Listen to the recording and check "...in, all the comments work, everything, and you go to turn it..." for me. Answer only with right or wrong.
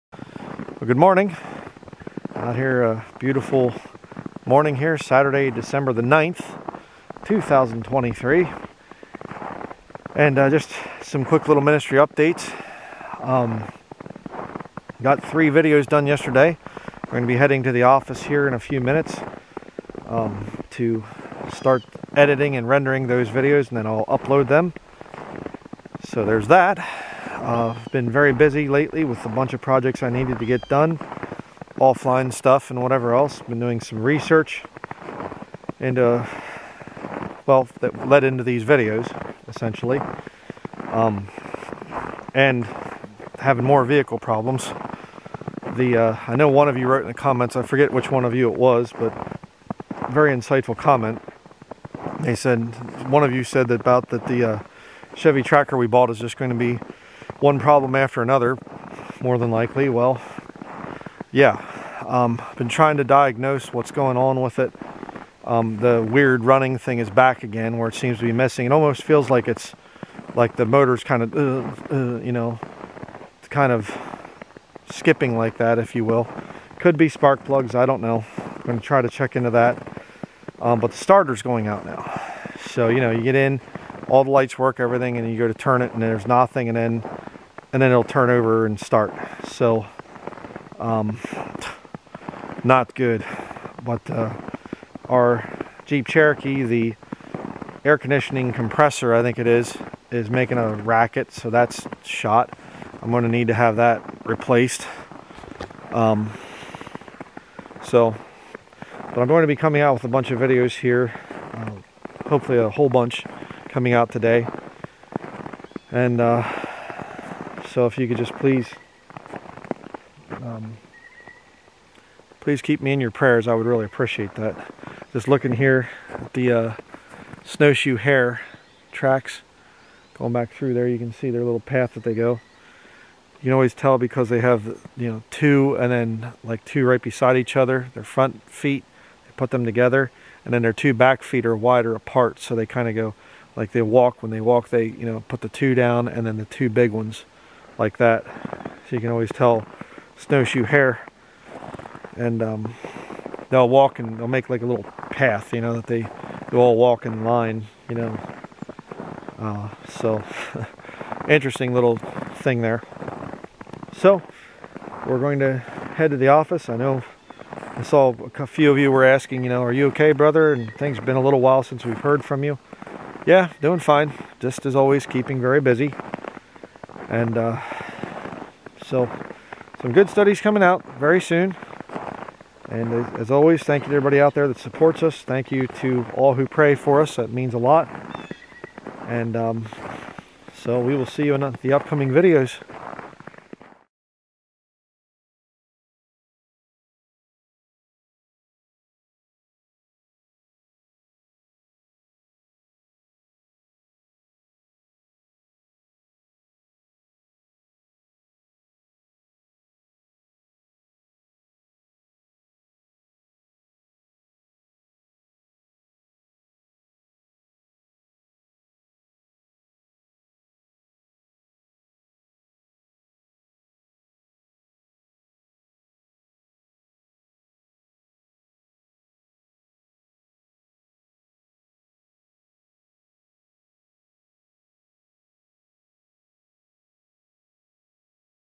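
wrong.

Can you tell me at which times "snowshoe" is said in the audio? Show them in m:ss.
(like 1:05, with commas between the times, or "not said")
2:07, 2:30.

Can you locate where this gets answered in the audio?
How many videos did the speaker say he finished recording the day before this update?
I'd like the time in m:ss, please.
0:15.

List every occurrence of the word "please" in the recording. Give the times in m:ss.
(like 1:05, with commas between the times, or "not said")
1:58, 2:02.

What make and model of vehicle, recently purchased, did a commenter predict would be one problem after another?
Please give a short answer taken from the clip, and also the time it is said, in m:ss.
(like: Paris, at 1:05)
Chevy Tracker, at 0:55.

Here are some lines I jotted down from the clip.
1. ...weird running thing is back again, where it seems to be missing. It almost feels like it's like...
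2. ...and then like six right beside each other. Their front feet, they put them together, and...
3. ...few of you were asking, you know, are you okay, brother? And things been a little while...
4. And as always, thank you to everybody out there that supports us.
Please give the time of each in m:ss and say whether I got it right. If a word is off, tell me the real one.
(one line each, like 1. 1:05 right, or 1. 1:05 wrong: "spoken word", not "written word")
1. 1:06 right
2. 2:15 wrong: "two", not "six"
3. 2:48 right
4. 3:02 right.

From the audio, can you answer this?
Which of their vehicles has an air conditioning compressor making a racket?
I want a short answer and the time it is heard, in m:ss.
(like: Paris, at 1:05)
Jeep Cherokee, at 1:35.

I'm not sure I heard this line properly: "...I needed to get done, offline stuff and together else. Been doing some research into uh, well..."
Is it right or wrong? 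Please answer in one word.
wrong.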